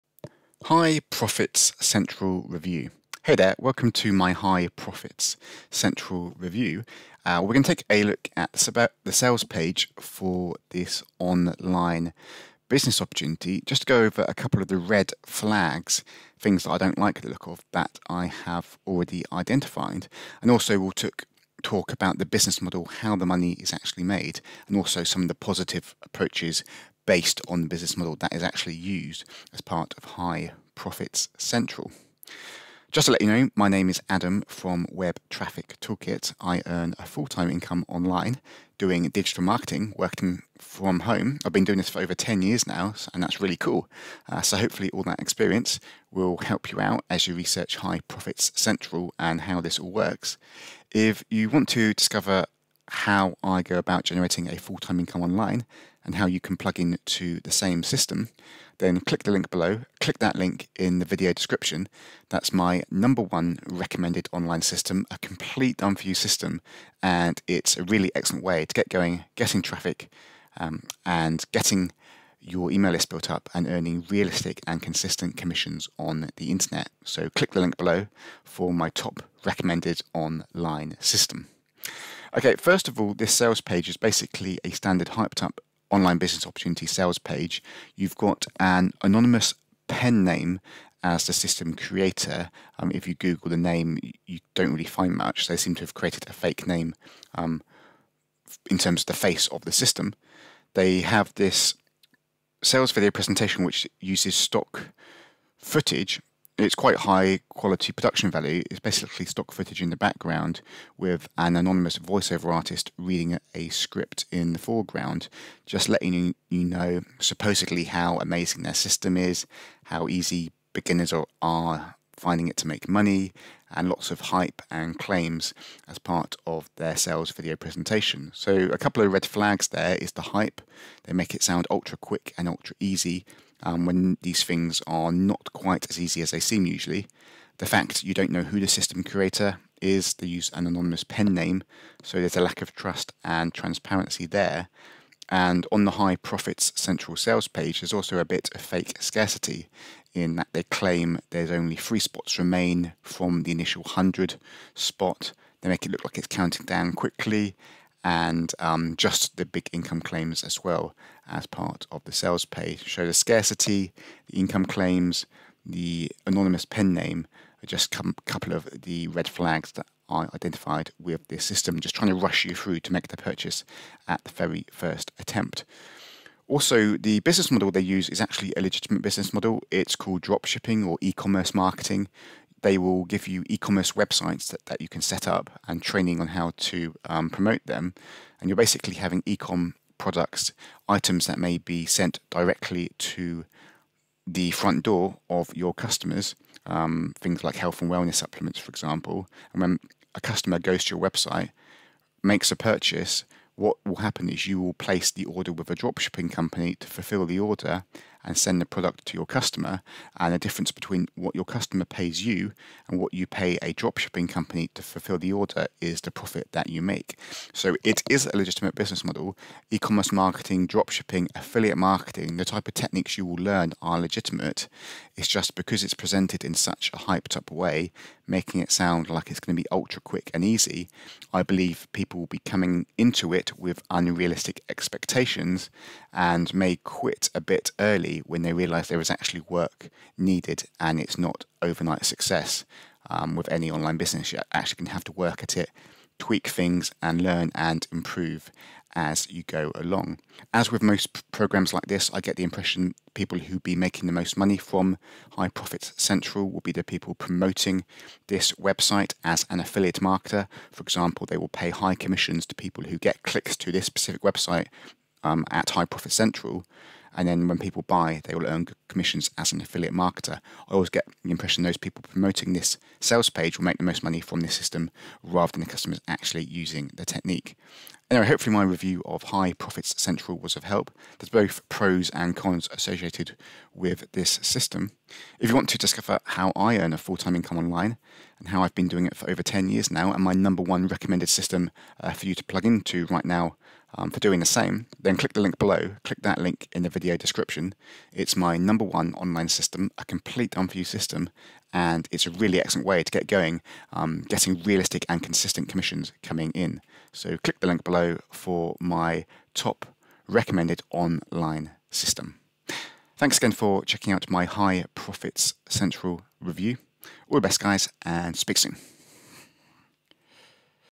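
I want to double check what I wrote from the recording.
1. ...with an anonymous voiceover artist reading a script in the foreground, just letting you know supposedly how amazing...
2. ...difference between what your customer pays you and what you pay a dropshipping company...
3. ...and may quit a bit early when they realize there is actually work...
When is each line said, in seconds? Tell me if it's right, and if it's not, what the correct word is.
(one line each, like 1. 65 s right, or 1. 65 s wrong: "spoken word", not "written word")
1. 110 s right
2. 210 s right
3. 236 s right.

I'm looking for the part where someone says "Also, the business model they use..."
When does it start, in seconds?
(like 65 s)
176 s.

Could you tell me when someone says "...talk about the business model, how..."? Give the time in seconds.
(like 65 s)
21 s.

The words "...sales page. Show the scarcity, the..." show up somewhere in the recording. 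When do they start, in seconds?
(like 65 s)
162 s.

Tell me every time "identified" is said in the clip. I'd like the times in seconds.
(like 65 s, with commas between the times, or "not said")
19 s, 170 s.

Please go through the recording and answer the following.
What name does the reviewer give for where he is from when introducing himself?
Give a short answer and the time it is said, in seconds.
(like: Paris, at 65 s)
Web Traffic Toolkit, at 34 s.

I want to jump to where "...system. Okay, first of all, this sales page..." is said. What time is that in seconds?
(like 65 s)
80 s.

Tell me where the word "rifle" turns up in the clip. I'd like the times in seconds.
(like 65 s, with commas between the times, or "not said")
not said.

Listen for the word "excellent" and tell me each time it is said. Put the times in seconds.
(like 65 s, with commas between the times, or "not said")
68 s, 302 s.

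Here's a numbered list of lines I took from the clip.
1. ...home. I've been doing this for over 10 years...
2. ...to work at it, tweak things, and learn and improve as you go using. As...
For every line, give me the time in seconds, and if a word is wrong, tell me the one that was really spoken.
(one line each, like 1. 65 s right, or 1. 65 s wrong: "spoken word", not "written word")
1. 41 s right
2. 245 s wrong: "along", not "using".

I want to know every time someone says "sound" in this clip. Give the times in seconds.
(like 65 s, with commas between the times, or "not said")
131 s, 228 s.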